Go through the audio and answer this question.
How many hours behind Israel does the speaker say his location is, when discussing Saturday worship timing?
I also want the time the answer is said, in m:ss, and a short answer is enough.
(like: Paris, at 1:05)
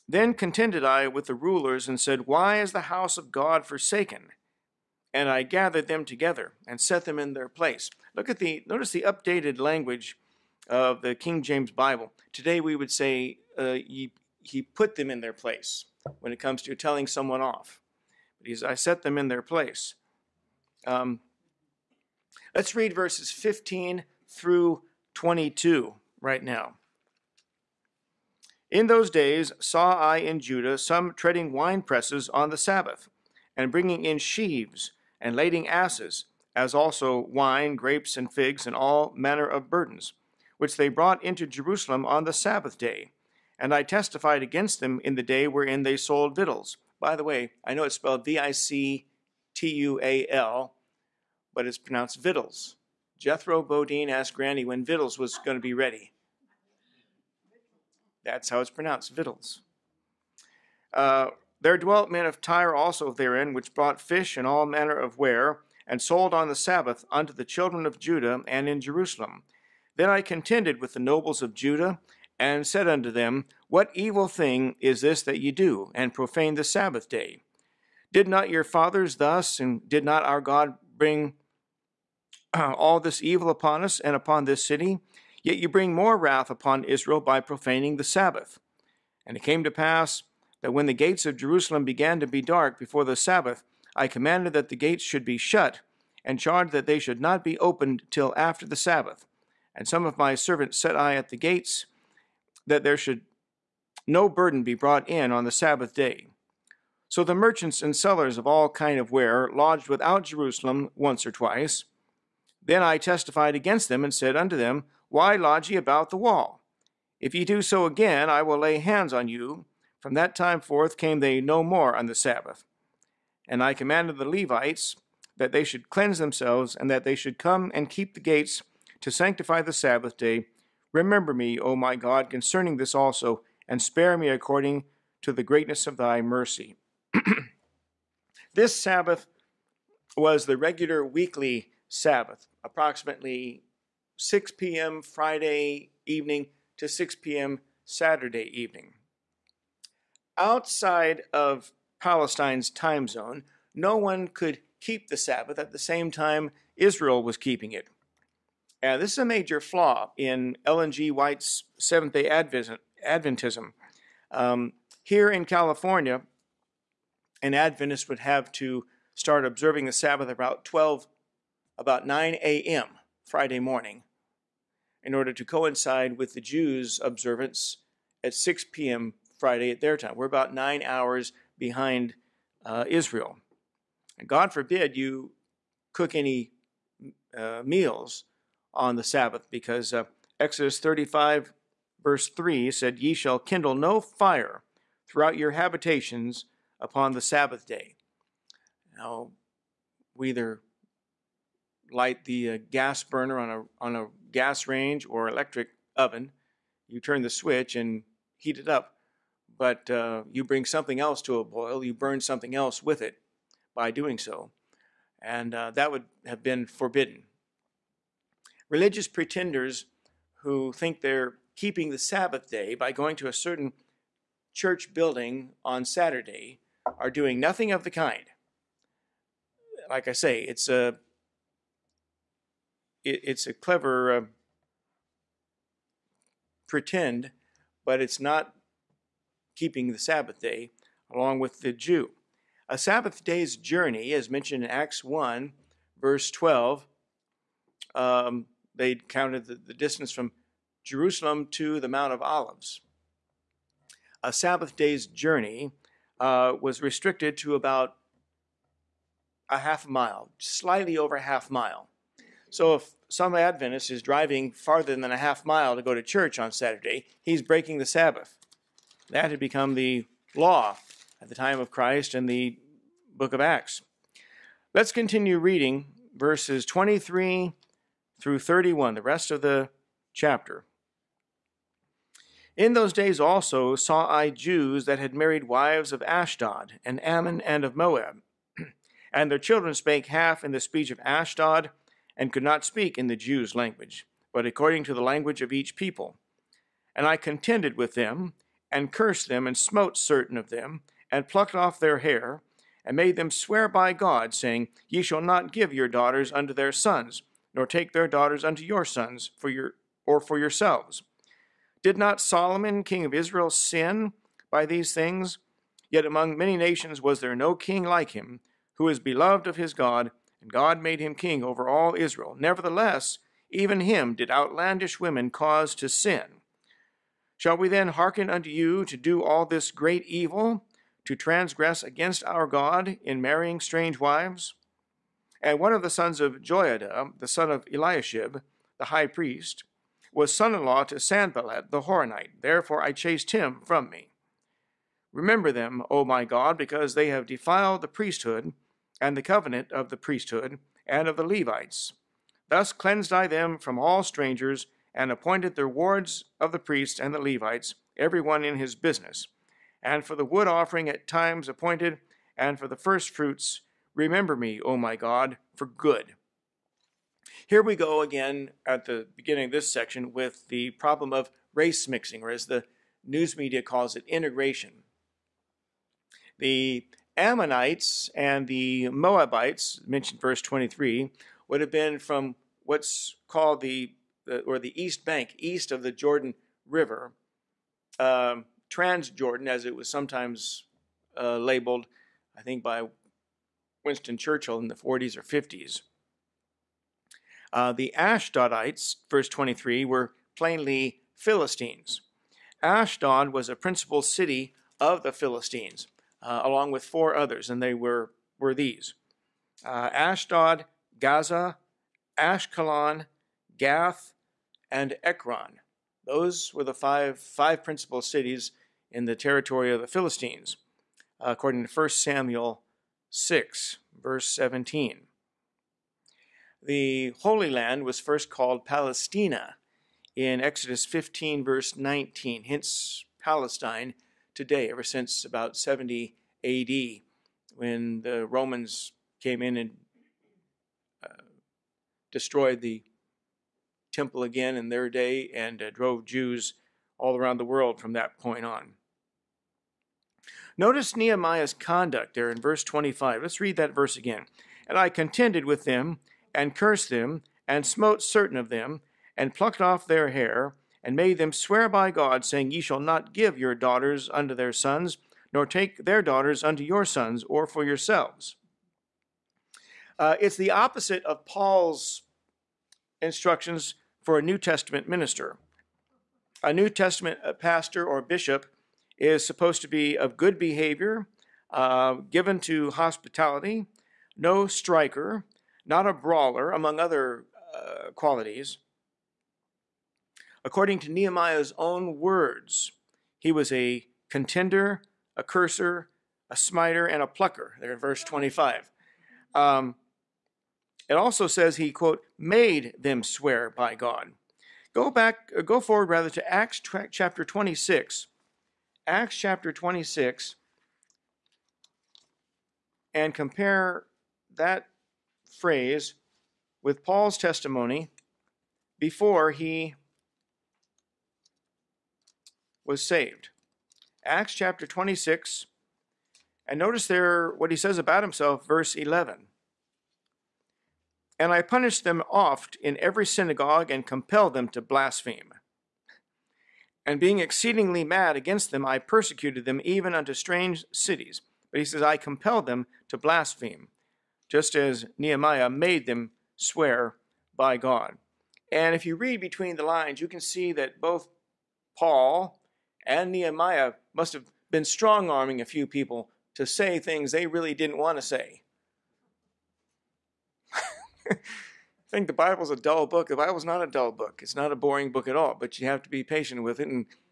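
9, at 3:00.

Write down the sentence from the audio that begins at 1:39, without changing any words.
And some of my servants set I at the gates, that there should no burden be brought in on the Sabbath day.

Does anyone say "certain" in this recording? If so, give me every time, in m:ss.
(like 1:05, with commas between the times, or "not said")
3:43, 4:59, 7:38.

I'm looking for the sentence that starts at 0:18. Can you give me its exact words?
But he's I set them in their place.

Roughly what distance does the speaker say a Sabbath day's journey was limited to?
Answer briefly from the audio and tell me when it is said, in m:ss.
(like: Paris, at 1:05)
about a half mile, at 4:17.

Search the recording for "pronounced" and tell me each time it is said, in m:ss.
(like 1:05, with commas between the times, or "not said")
0:51, 0:58.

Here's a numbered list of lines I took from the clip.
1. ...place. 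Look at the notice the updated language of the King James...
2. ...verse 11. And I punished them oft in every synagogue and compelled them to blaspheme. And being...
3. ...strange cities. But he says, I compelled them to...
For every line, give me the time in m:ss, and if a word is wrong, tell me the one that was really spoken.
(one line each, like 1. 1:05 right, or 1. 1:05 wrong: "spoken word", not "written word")
1. 0:07 right
2. 8:48 right
3. 9:00 right.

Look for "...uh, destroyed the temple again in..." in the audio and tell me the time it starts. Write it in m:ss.
7:21.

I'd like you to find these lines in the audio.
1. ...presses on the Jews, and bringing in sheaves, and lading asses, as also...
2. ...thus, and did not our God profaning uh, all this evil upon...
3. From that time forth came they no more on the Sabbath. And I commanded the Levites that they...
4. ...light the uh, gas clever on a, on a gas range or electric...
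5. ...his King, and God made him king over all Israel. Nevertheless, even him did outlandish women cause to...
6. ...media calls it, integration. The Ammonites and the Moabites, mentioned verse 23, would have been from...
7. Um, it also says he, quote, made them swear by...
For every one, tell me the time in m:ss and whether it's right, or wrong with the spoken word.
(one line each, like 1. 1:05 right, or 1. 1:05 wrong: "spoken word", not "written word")
1. 0:31 wrong: "Sabbath", not "Jews"
2. 1:19 wrong: "bring", not "profaning"
3. 2:00 right
4. 3:21 wrong: "burner", not "clever"
5. 5:19 wrong: "God", not "King"
6. 6:13 right
7. 8:19 right.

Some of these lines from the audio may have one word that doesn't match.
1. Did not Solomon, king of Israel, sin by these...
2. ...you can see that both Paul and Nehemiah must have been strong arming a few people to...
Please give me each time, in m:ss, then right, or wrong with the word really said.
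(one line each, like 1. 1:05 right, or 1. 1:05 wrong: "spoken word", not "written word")
1. 5:11 right
2. 9:10 right.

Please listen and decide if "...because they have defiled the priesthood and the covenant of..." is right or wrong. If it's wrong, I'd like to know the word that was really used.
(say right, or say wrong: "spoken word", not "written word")
right.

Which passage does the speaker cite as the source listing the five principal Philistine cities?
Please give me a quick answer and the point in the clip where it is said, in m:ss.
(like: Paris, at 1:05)
1 Samuel 6:17, at 7:01.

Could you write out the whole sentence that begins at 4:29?
That had become the law at the time of Christ and the book of Acts.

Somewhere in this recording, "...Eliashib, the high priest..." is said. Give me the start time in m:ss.
5:37.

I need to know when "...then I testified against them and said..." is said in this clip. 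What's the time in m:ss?
1:52.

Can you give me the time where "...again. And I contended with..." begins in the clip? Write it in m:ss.
7:33.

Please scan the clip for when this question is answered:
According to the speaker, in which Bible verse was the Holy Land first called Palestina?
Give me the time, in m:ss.
7:10.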